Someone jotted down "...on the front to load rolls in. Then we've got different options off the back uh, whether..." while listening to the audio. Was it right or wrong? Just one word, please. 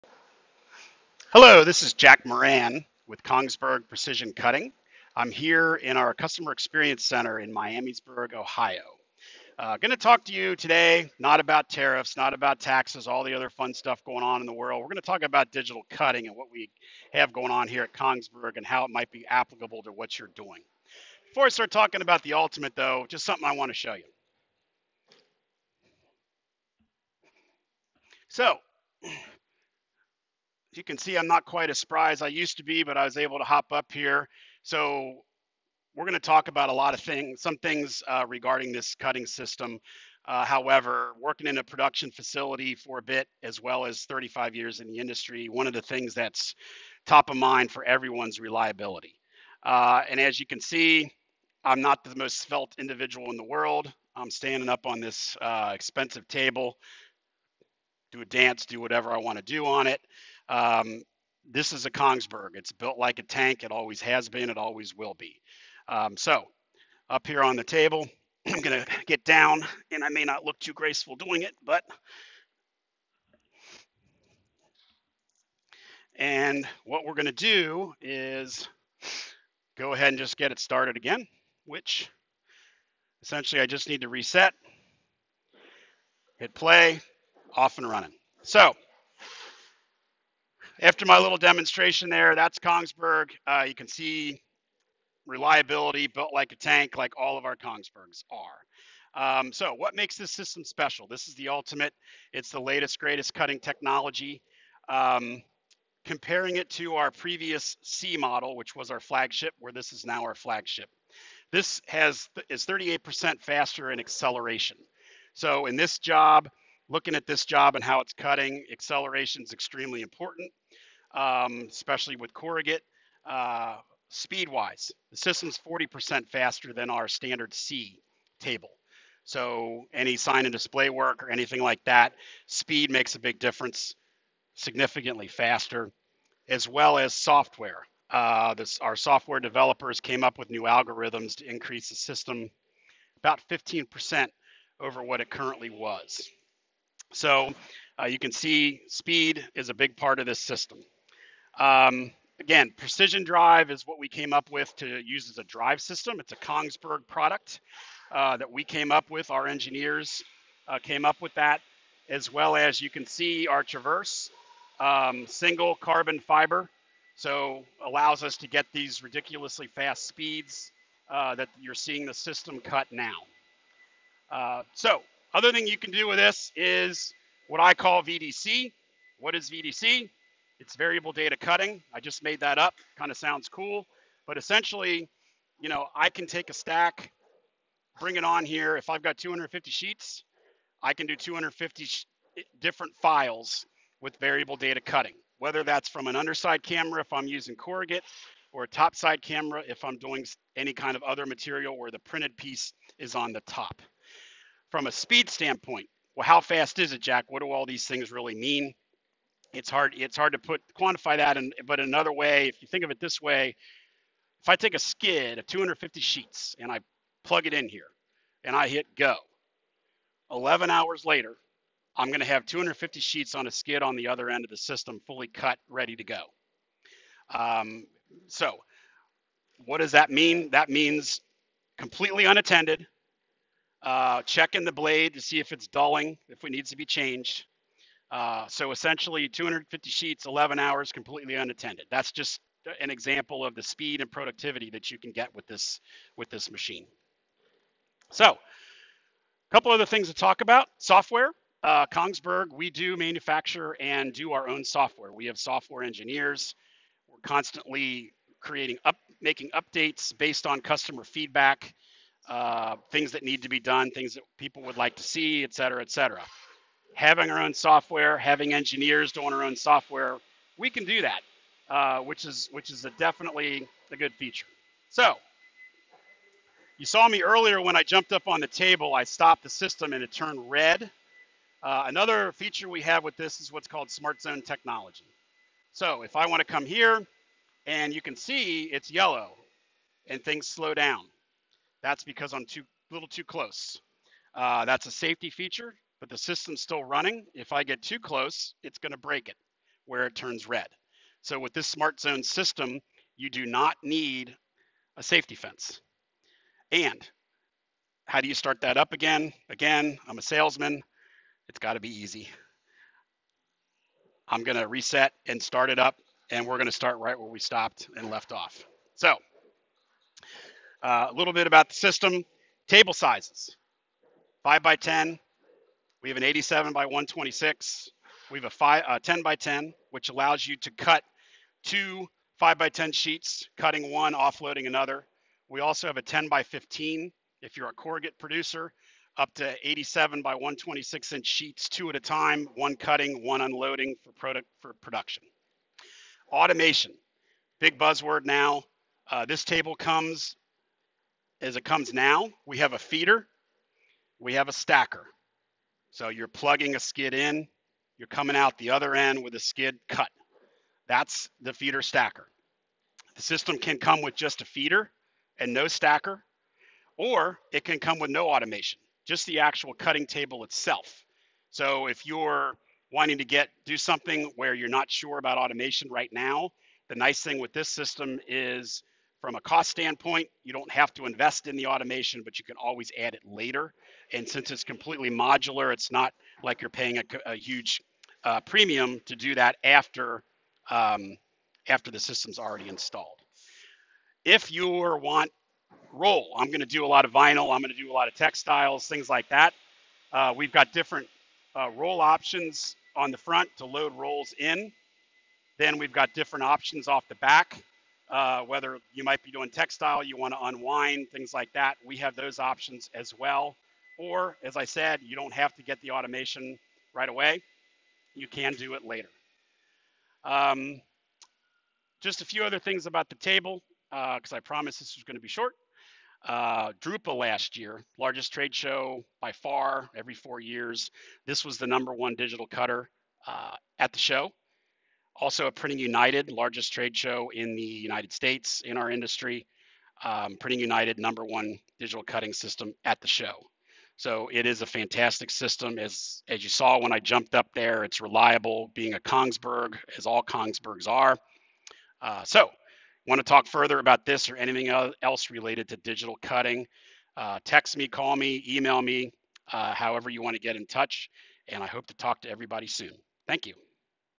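right.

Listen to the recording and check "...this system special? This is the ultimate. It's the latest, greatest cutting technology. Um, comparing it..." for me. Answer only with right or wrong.
right.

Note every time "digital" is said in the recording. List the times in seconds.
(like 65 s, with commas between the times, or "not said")
15 s, 432 s, 441 s, 455 s.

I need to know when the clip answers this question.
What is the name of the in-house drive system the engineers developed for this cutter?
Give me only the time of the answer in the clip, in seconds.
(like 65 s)
152 s.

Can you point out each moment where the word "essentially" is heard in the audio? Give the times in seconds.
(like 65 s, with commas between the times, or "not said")
83 s, 184 s, 238 s.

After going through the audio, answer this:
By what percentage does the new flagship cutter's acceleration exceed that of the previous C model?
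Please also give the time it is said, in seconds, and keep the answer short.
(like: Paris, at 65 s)
38%, at 112 s.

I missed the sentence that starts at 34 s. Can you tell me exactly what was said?
So we're going to talk about a lot of things, some things uh, regarding this cutting system.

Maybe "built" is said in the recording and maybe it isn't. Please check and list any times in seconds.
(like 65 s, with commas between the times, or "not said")
62 s, 96 s.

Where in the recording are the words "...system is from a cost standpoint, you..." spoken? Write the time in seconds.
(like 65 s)
377 s.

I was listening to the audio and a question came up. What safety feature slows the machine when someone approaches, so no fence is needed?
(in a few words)
smart zone technology.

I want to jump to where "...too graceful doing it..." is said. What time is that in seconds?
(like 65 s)
70 s.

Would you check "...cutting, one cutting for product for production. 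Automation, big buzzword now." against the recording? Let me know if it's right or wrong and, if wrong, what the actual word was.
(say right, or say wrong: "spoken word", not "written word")
wrong: "unloading", not "cutting".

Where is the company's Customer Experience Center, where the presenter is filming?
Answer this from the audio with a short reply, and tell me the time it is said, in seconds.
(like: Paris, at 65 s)
Miamisburg, Ohio, at 7 s.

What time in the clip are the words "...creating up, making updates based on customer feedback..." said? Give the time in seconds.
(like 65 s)
258 s.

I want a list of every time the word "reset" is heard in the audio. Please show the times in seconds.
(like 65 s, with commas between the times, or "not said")
84 s, 314 s.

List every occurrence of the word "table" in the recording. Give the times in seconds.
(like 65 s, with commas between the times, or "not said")
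56 s, 67 s, 128 s, 278 s, 322 s, 349 s, 370 s, 423 s.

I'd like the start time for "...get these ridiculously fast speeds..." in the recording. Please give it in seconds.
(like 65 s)
168 s.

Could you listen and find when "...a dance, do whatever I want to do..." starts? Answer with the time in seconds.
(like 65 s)
58 s.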